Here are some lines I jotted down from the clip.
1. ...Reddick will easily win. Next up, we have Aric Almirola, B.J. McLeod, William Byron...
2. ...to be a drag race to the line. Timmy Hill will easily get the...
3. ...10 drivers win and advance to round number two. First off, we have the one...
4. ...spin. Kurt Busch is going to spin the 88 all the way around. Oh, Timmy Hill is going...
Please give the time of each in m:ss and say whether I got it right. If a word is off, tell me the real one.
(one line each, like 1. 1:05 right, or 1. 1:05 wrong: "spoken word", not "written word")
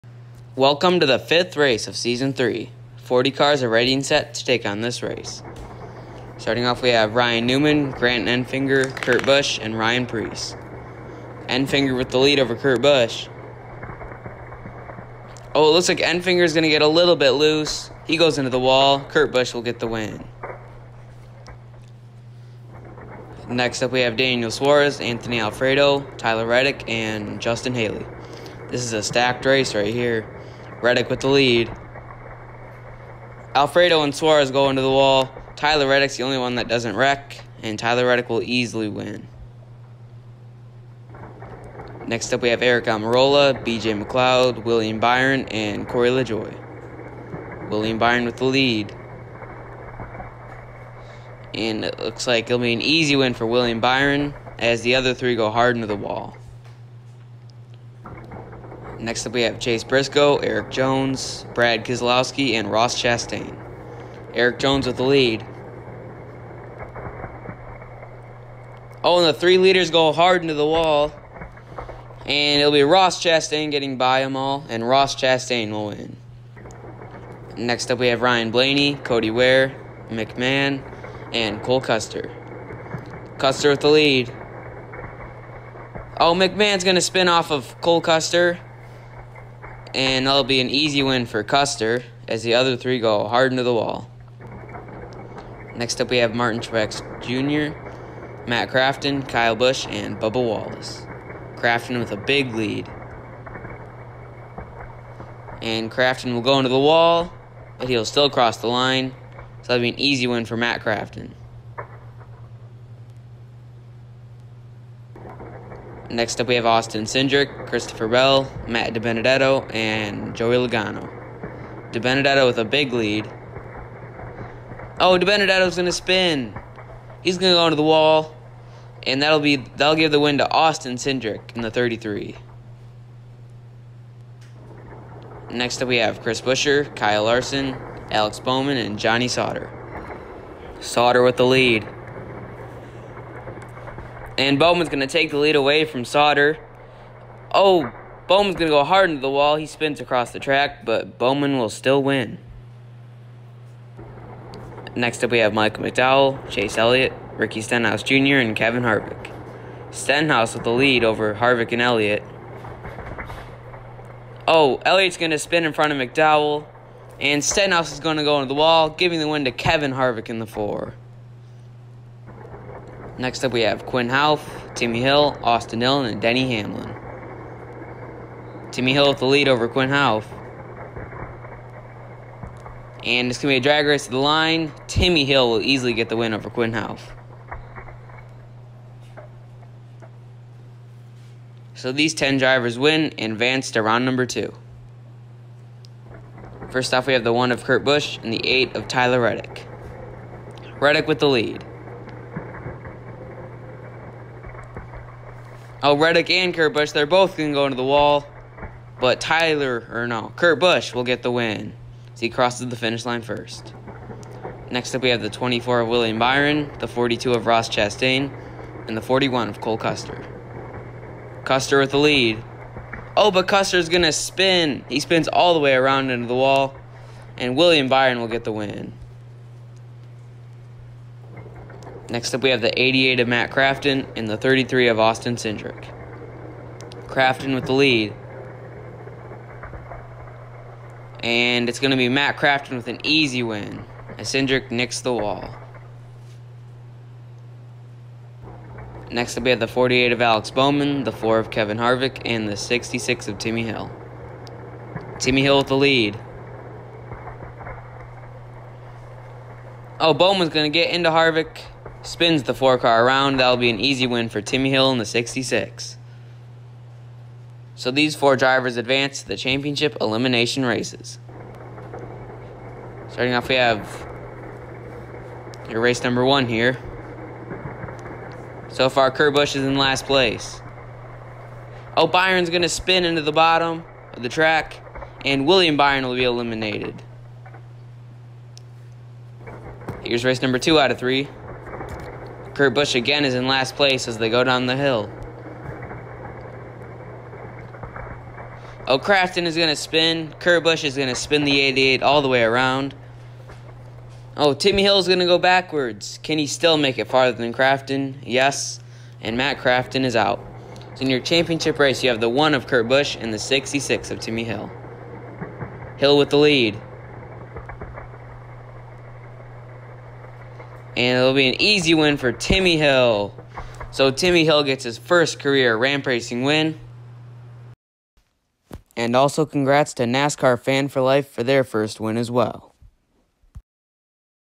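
1. 0:38 right
2. 3:03 right
3. 3:12 right
4. 4:59 right.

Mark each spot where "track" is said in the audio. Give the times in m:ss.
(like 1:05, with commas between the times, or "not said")
2:30, 4:44.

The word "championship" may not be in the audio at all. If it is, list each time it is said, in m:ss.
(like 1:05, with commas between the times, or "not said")
4:29, 5:11.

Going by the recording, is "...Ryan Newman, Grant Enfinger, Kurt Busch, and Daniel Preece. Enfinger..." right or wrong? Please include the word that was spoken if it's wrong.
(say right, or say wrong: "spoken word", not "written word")
wrong: "Ryan", not "Daniel".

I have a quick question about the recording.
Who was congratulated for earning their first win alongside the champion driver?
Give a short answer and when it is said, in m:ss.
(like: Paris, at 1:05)
NASCAR Fan for Life, at 5:30.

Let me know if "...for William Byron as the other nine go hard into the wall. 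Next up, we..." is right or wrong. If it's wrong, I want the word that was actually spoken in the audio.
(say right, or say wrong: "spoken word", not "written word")
wrong: "three", not "nine".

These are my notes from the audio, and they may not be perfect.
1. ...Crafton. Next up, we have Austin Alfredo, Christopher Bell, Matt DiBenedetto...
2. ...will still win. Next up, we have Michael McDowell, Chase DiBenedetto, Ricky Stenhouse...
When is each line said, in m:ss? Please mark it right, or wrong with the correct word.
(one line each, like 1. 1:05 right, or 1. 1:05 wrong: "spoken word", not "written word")
1. 1:50 wrong: "Cindric", not "Alfredo"
2. 2:31 wrong: "Elliott", not "DiBenedetto".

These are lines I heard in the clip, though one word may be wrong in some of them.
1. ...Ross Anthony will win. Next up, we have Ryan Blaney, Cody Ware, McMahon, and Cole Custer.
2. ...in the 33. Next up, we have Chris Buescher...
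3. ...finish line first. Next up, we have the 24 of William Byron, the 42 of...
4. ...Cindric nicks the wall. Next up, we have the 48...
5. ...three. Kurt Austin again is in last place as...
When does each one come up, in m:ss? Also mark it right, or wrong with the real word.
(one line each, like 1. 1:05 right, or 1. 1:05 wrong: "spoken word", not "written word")
1. 1:14 wrong: "Chastain", not "Anthony"
2. 2:11 right
3. 3:32 right
4. 4:04 right
5. 4:50 wrong: "Busch", not "Austin".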